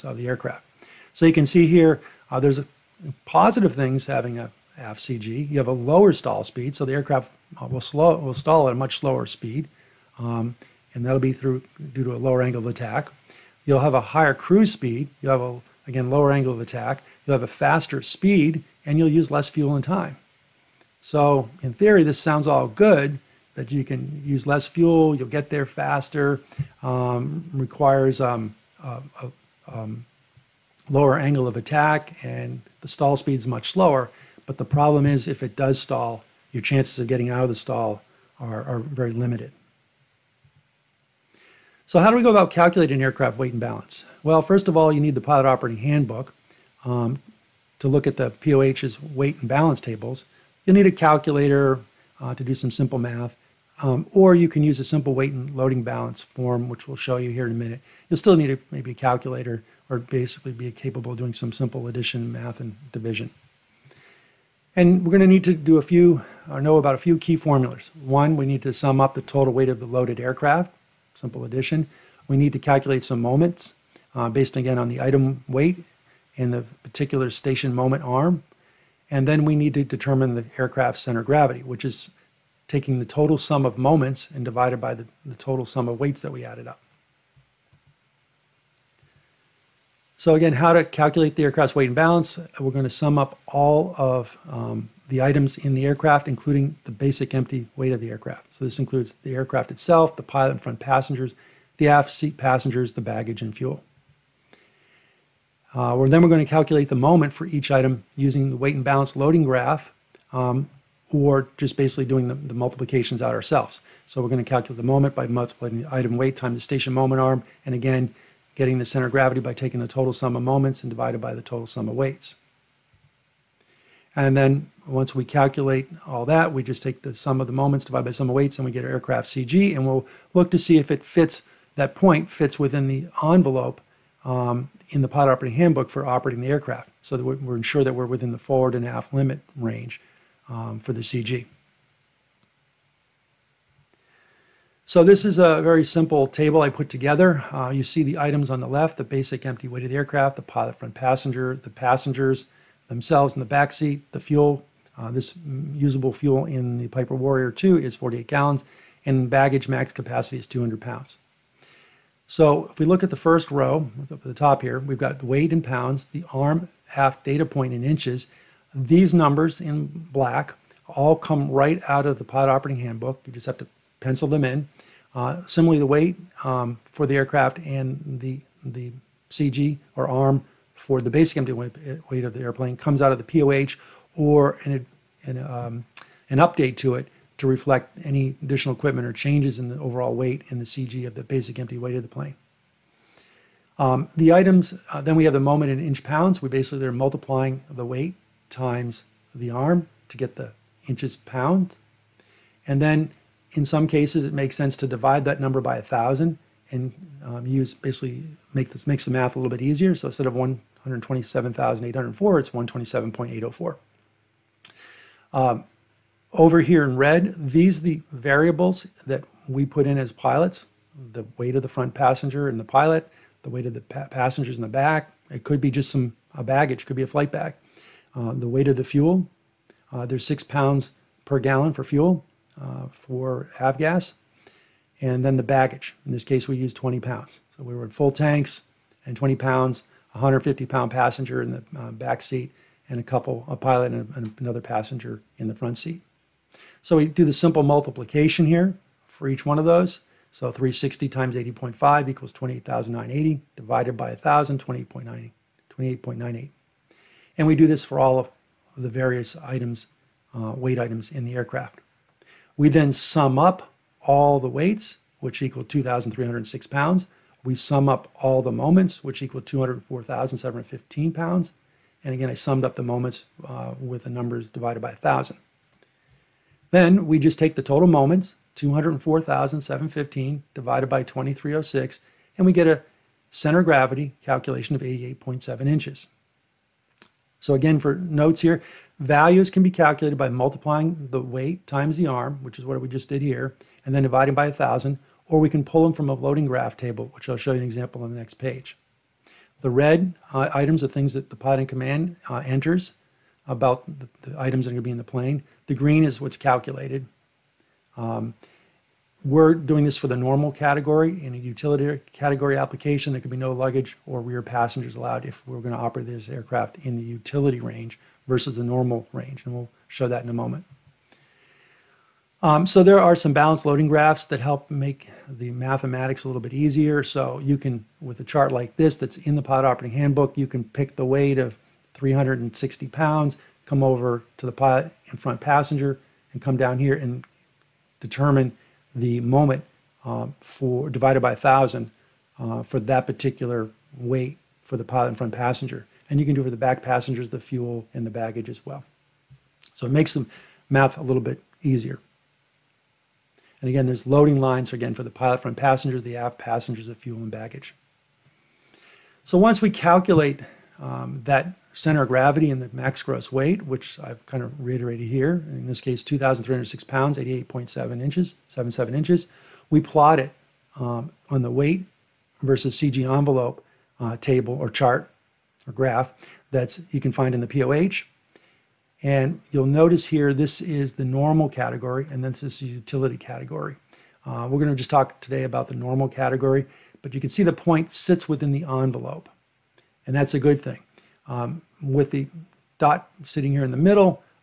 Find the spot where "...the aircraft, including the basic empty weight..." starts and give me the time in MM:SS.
01:35.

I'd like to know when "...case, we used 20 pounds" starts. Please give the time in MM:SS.
03:56.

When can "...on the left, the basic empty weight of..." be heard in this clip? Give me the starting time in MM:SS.
02:28.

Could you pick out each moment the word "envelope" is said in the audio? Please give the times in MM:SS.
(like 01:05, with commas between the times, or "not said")
02:13, 06:13, 06:28.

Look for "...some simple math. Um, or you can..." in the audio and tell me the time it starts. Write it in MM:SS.
00:52.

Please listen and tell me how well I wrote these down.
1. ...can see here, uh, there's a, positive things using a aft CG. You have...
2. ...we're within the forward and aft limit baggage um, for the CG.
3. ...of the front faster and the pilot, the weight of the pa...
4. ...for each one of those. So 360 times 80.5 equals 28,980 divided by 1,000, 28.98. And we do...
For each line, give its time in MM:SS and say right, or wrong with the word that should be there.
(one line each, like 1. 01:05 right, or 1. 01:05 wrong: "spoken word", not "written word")
1. 00:01 wrong: "having", not "using"
2. 02:17 wrong: "range", not "baggage"
3. 03:41 wrong: "passenger", not "faster"
4. 04:09 right.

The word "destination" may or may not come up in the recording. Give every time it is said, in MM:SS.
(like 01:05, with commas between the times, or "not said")
not said.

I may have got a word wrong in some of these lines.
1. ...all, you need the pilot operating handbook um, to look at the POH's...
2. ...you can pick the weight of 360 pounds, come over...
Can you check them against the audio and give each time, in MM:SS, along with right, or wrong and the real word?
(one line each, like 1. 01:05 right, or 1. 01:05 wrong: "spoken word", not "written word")
1. 00:44 right
2. 05:30 right.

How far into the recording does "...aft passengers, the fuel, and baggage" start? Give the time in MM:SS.
05:56.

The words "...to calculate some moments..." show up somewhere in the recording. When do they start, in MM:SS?
01:12.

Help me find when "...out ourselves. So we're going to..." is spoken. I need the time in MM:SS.
01:53.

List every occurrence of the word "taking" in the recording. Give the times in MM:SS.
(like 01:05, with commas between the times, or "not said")
01:22, 01:59.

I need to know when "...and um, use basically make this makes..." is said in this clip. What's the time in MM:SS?
03:26.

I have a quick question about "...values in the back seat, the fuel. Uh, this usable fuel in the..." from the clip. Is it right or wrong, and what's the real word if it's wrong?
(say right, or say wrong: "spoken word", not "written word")
wrong: "themselves", not "values".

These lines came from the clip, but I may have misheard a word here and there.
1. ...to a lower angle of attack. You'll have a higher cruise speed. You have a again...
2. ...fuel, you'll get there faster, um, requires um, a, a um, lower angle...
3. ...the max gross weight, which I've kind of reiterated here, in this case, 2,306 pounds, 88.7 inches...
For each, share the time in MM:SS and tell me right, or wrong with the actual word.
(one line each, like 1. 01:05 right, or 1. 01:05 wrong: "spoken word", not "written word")
1. 00:12 right
2. 00:24 right
3. 06:02 right.